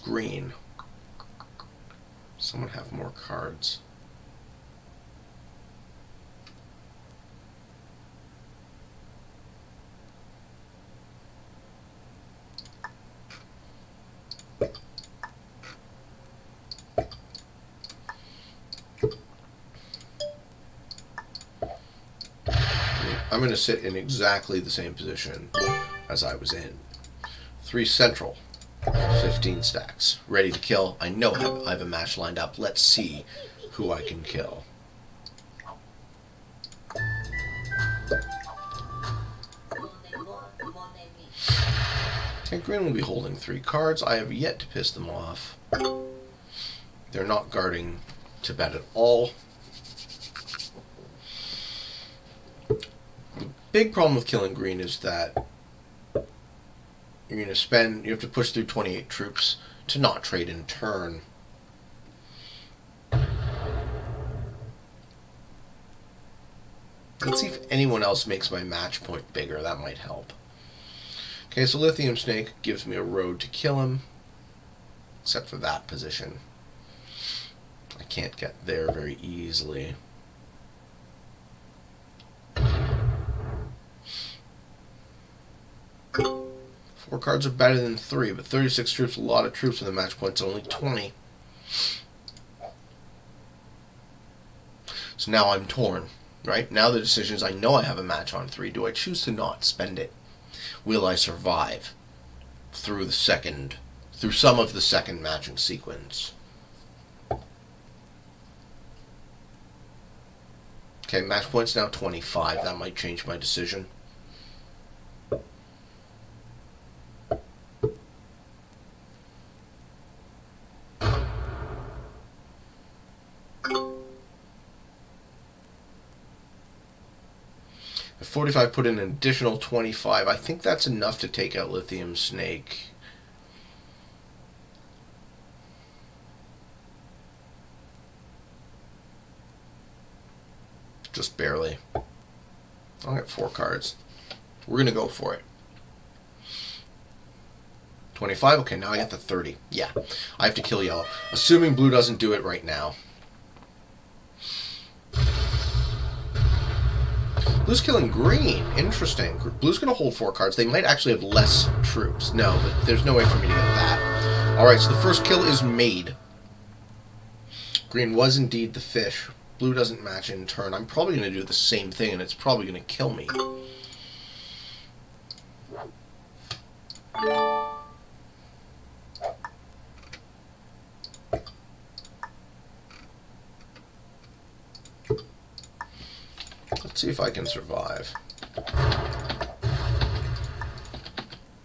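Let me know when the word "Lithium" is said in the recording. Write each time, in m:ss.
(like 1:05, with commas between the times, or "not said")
1:11, 2:11.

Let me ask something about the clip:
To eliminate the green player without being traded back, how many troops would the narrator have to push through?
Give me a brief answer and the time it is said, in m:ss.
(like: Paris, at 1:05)
28, at 0:58.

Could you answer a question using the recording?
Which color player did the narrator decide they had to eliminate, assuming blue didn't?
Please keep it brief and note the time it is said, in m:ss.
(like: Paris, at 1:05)
Yellow, at 2:30.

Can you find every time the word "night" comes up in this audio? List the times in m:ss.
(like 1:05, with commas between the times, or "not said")
not said.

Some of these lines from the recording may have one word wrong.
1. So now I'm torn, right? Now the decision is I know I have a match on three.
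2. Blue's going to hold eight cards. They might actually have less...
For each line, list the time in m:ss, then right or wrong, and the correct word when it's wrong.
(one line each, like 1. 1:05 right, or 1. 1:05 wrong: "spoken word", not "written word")
1. 1:35 right
2. 2:39 wrong: "four", not "eight".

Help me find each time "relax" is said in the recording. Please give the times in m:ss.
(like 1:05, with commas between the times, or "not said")
not said.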